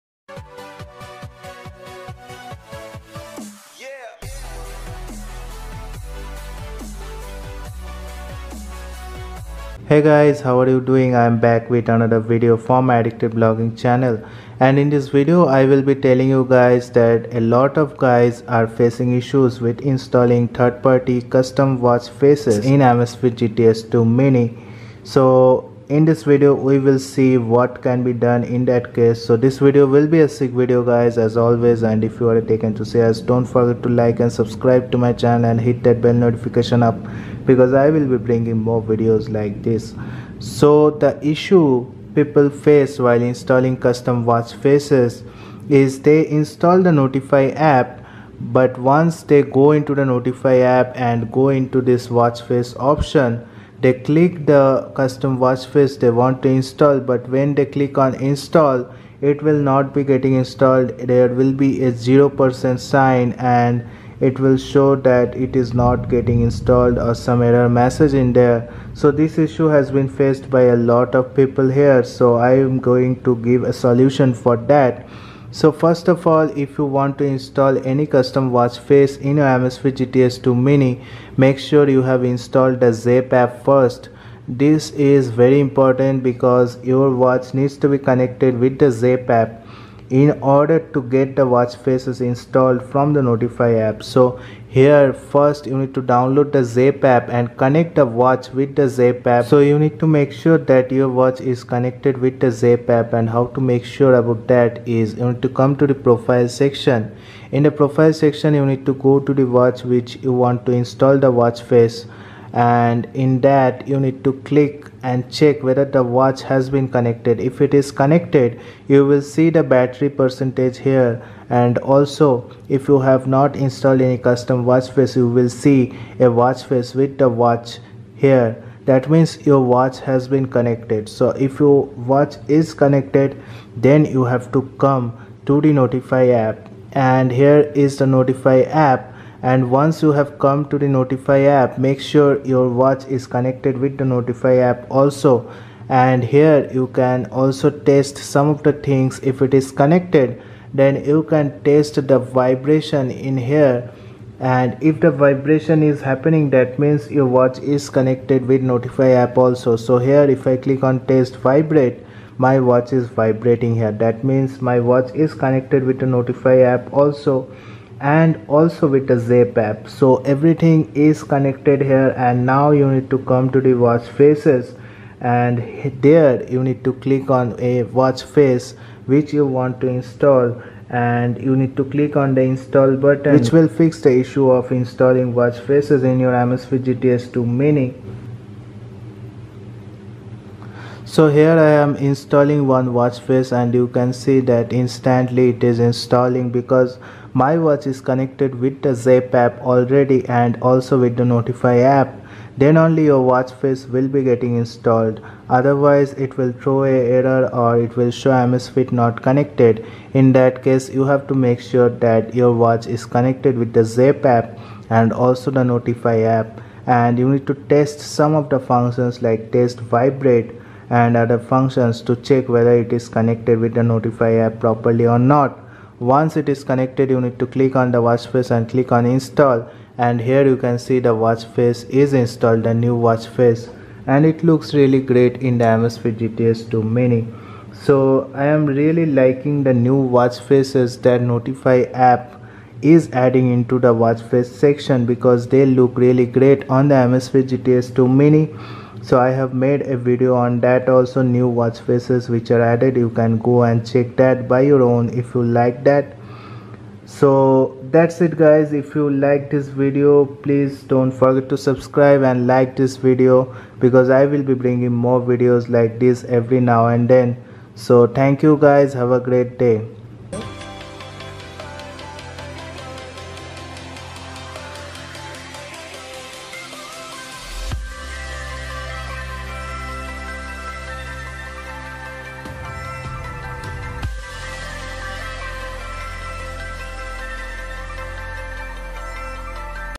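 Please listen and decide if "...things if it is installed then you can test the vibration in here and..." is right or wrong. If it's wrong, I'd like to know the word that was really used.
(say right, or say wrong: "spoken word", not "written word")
wrong: "connected", not "installed".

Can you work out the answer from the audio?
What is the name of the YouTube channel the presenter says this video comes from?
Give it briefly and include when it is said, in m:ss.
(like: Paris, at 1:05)
Addicted Blogging, at 0:12.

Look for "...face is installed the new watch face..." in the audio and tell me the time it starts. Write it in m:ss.
3:51.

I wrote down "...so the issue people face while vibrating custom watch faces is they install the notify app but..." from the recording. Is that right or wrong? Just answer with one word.
wrong.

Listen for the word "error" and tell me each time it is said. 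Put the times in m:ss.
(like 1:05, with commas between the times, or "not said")
1:07, 3:26.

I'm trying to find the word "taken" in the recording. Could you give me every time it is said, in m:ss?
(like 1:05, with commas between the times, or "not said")
0:32.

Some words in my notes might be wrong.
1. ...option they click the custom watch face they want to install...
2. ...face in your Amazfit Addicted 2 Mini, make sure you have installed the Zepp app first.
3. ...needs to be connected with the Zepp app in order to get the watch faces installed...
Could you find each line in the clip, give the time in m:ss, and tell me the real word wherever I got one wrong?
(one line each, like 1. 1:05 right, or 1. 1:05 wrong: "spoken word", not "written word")
1. 0:52 right
2. 1:18 wrong: "GTS", not "Addicted"
3. 1:27 right.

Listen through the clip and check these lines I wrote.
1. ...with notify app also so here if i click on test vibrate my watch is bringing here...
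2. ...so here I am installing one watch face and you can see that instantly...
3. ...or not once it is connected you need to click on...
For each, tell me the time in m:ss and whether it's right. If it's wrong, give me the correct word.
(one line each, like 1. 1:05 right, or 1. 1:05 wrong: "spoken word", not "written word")
1. 2:38 wrong: "vibrating", not "bringing"
2. 3:11 right
3. 3:45 right.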